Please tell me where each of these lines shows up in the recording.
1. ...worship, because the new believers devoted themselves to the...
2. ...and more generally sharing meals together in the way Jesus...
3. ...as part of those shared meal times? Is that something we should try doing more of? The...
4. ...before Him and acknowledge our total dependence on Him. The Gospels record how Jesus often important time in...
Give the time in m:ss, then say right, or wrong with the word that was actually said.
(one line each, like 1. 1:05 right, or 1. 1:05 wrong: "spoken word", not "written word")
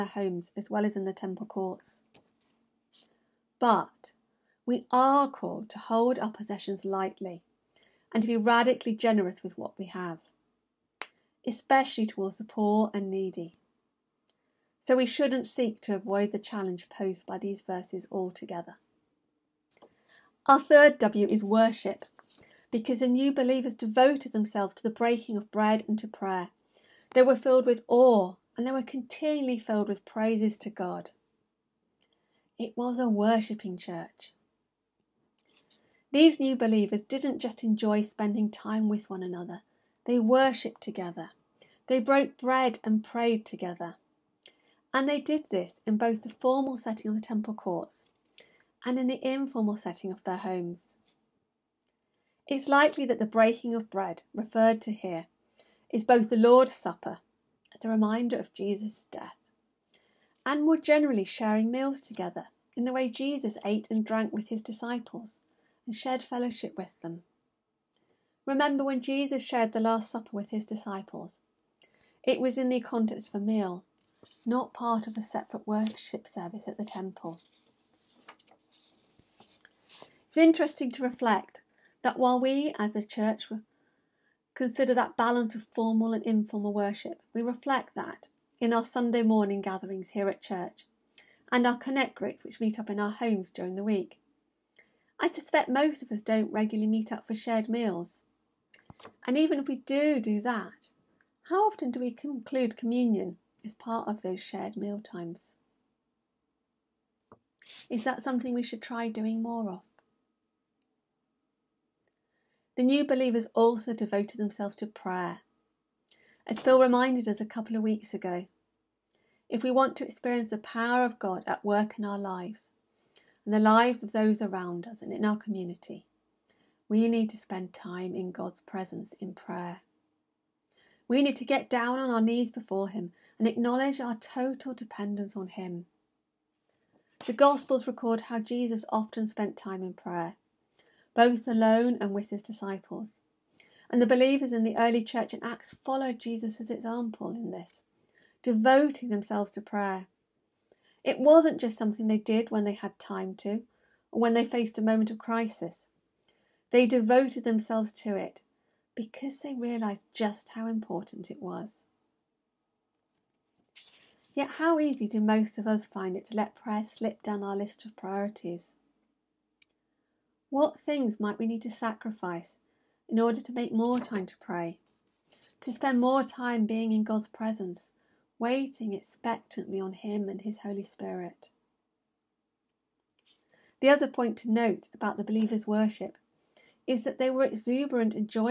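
1. 0:21 right
2. 1:00 right
3. 1:43 right
4. 2:12 wrong: "spent", not "important".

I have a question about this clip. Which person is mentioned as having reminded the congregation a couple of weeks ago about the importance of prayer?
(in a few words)
Phil.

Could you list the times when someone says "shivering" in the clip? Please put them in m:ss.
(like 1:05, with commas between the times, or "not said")
not said.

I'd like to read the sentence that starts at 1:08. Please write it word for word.
Remember when Jesus shared the Last Supper with his disciples?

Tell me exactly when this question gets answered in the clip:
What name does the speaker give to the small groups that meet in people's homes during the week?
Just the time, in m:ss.
1:31.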